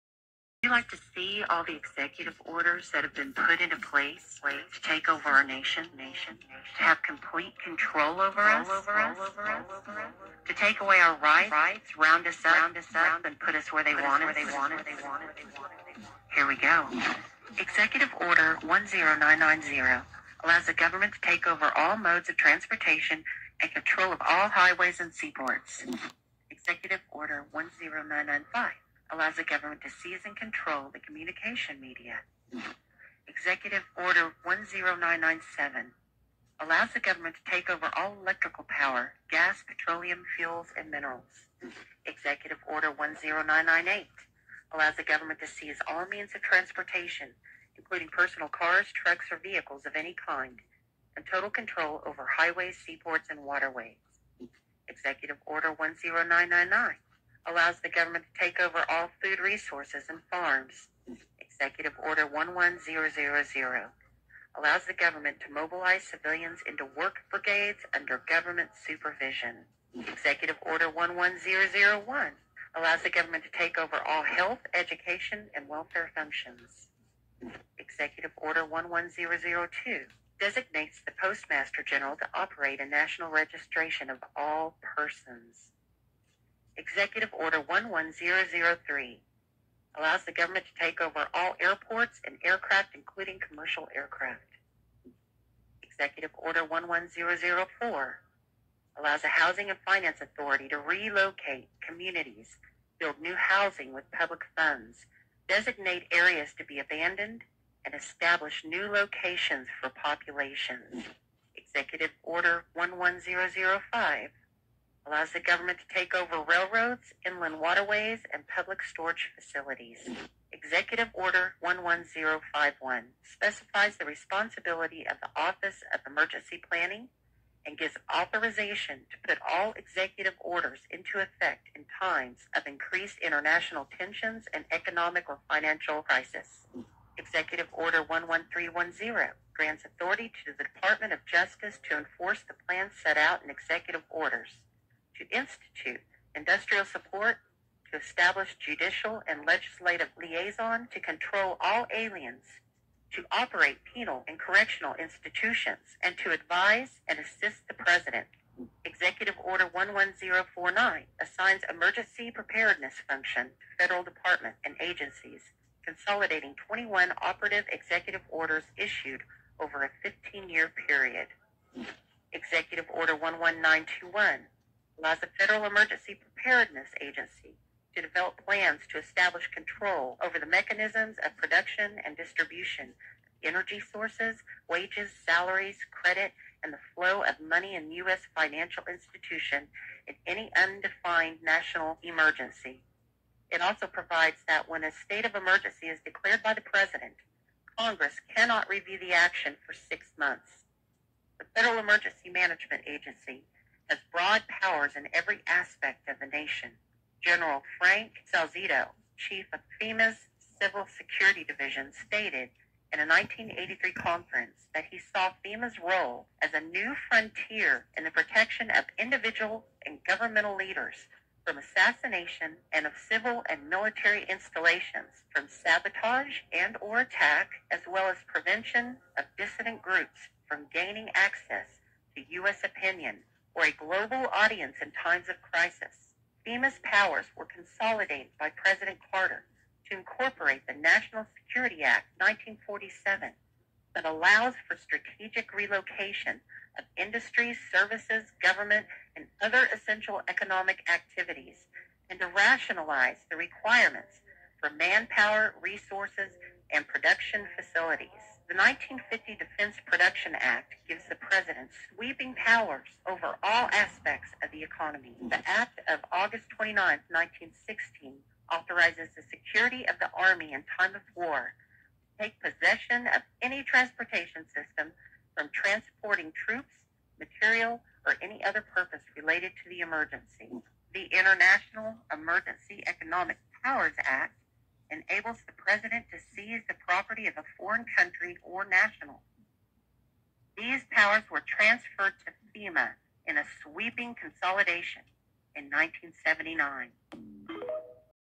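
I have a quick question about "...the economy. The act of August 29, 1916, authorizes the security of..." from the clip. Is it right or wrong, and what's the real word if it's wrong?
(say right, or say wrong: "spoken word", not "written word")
right.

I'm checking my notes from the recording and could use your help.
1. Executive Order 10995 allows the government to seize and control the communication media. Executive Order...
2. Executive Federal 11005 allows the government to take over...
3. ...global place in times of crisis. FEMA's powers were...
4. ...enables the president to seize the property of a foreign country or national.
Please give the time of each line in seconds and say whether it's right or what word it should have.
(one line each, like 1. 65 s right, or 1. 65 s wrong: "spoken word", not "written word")
1. 26 s right
2. 111 s wrong: "Order", not "Federal"
3. 233 s wrong: "audience", not "place"
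4. 284 s right.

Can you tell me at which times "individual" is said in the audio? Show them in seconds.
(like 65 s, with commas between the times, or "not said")
218 s.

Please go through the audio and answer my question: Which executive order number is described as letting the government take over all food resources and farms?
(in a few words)
10999.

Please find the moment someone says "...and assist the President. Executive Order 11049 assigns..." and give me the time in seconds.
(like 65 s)
157 s.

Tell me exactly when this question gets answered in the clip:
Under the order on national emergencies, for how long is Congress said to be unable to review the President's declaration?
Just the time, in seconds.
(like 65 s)
199 s.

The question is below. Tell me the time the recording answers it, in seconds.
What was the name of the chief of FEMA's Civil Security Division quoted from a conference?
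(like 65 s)
207 s.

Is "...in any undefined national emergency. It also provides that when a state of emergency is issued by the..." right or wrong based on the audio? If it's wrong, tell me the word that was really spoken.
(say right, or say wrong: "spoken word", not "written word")
wrong: "declared", not "issued".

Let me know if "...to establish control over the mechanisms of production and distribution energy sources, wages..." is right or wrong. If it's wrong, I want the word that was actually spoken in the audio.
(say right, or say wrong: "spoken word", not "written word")
right.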